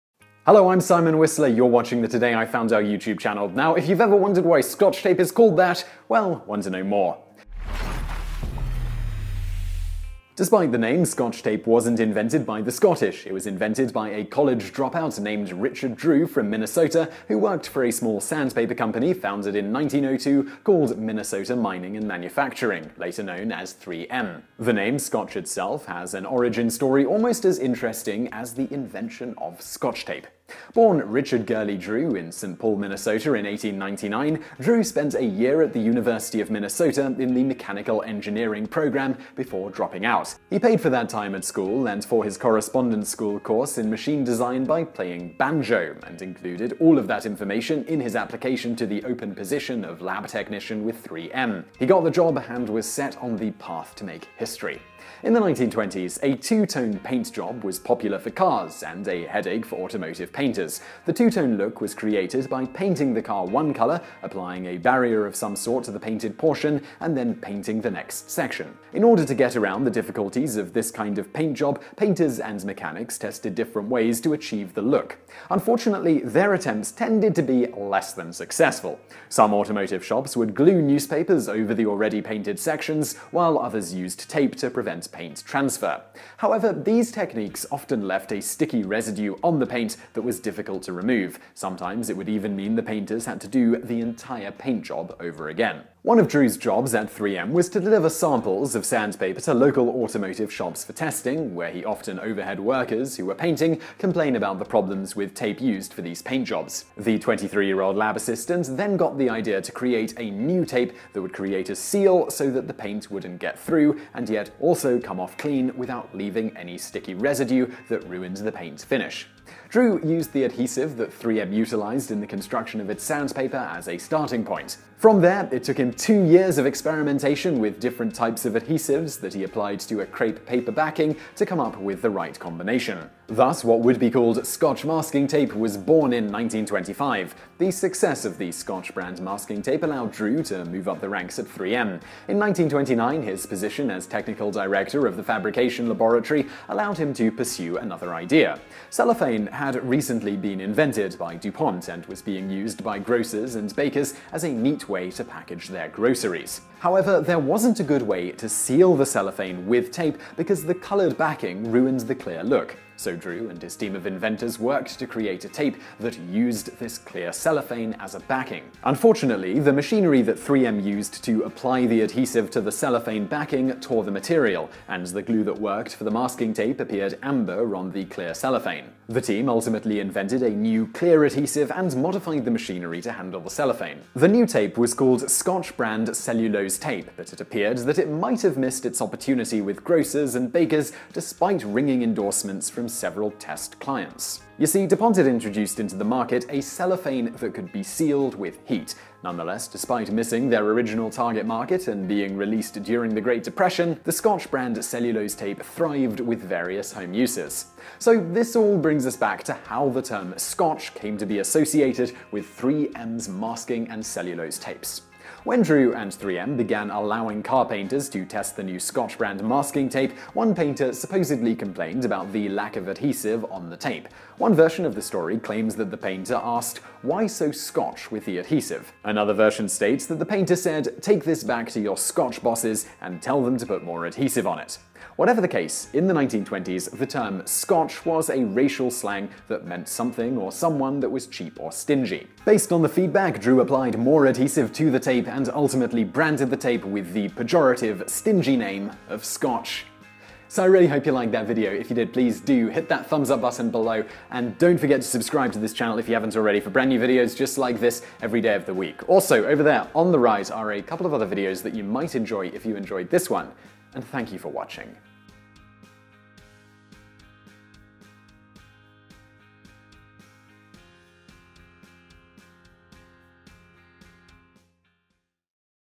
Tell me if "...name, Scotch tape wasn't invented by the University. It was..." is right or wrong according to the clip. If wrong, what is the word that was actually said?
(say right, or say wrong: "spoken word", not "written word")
wrong: "Scottish", not "University".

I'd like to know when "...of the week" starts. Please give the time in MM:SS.
04:18.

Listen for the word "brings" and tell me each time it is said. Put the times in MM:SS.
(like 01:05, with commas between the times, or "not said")
03:28.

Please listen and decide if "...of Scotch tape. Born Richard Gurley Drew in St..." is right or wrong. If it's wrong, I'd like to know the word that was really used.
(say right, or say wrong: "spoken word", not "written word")
right.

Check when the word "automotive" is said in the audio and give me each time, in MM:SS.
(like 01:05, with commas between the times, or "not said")
00:59, 01:19, 01:39.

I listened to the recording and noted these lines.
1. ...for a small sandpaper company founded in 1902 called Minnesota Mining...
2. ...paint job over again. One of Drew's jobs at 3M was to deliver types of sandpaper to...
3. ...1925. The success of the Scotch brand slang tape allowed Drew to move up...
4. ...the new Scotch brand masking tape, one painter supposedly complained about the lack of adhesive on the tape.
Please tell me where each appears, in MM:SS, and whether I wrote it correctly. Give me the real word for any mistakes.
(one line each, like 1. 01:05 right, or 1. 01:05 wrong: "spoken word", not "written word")
1. 00:17 right
2. 01:34 wrong: "samples", not "types"
3. 02:16 wrong: "masking", not "slang"
4. 03:38 right.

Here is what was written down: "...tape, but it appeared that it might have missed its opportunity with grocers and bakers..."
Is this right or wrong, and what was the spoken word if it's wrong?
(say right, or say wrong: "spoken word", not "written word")
right.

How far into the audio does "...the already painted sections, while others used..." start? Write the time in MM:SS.
01:21.